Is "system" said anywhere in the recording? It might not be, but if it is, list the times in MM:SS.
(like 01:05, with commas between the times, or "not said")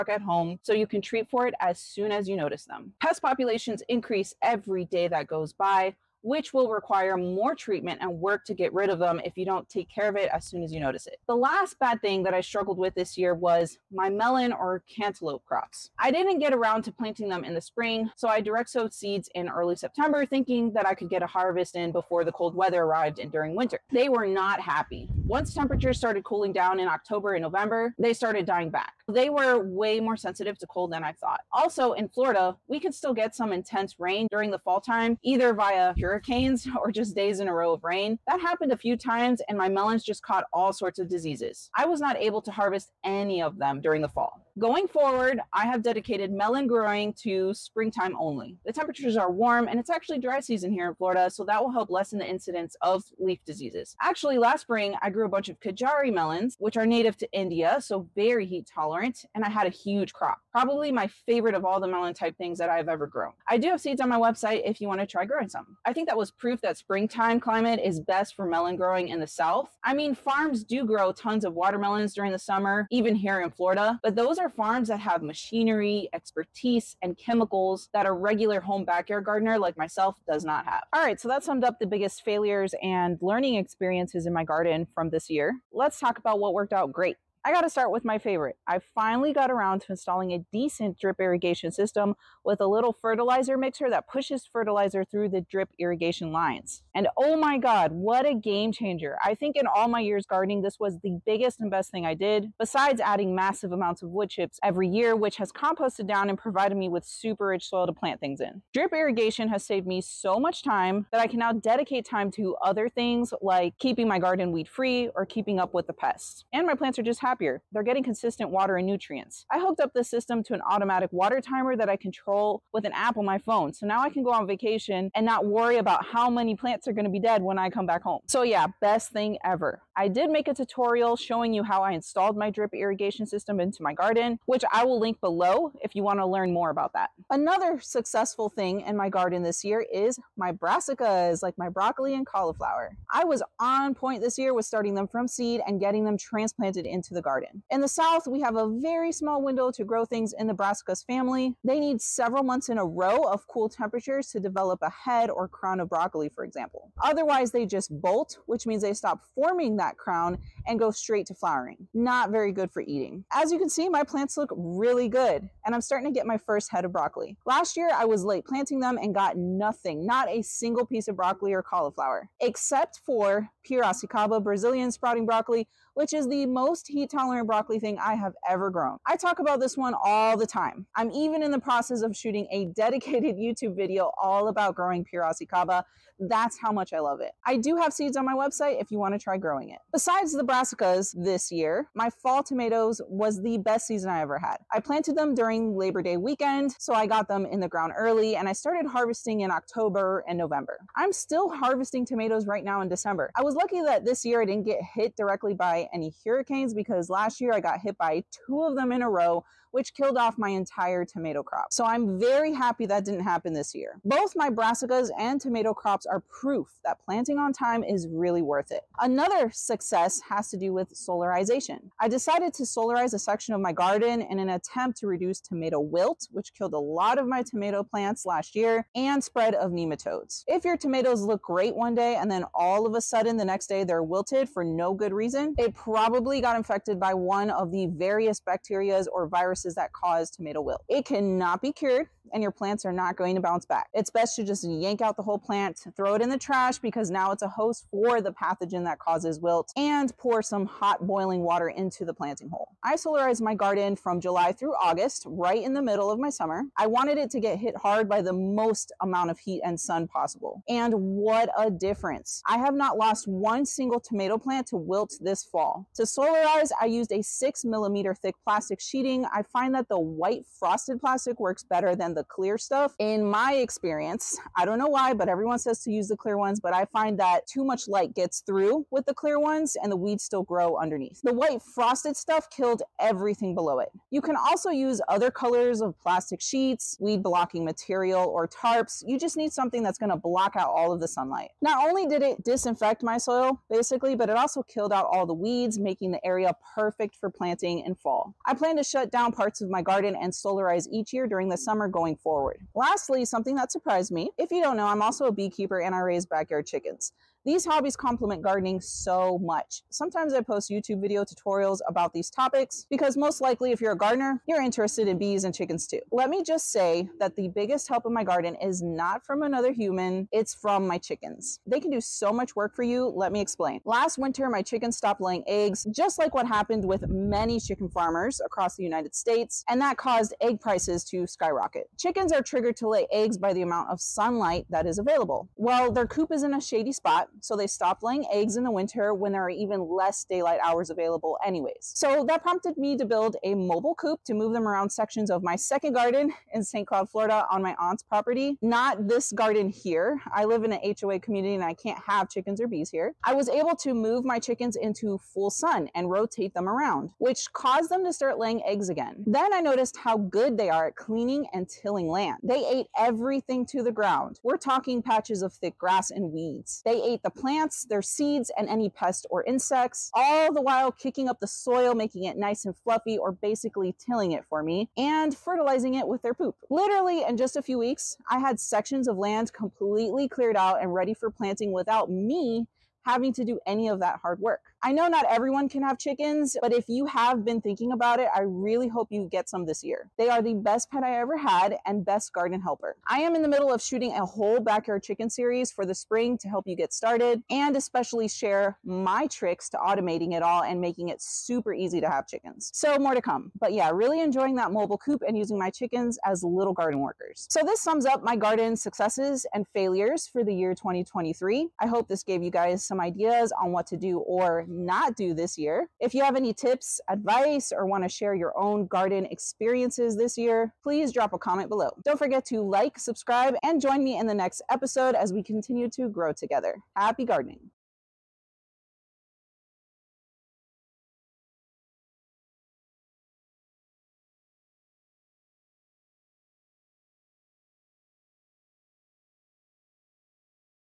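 01:31, 02:00, 02:13.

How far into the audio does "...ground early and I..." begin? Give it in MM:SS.
03:17.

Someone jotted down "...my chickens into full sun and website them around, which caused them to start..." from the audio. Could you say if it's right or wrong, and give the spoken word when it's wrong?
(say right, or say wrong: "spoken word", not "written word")
wrong: "rotate", not "website".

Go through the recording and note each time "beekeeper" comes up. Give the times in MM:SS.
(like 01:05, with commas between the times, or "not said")
05:05.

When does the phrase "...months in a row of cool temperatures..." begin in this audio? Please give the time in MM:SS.
02:32.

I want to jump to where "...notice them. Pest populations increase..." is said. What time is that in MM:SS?
00:02.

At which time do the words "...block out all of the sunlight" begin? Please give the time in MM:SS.
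04:50.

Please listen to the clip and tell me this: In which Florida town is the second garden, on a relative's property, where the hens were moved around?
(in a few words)
St. Cloud.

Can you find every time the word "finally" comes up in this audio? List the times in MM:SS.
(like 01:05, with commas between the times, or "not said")
01:28.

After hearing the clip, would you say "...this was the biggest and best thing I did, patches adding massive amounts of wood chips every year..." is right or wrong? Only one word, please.
wrong.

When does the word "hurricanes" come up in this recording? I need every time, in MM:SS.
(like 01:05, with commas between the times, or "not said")
00:36, 03:26.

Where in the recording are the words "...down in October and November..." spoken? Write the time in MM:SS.
00:26.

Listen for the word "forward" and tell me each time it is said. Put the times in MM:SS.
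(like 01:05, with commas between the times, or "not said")
00:44, 05:02.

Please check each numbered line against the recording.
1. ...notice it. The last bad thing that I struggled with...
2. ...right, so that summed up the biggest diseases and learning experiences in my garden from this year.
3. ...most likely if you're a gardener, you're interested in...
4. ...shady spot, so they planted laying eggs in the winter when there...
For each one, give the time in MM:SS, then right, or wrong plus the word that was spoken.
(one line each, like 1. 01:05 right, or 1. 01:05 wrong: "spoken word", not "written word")
1. 00:10 right
2. 01:21 wrong: "failures", not "diseases"
3. 05:13 right
4. 05:36 wrong: "stopped", not "planted".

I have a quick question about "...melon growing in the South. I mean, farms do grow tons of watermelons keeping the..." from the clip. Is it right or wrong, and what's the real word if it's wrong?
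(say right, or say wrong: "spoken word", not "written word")
wrong: "during", not "keeping".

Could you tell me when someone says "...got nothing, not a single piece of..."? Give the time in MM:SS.
02:49.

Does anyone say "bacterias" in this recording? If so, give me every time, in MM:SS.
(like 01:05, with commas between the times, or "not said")
03:58.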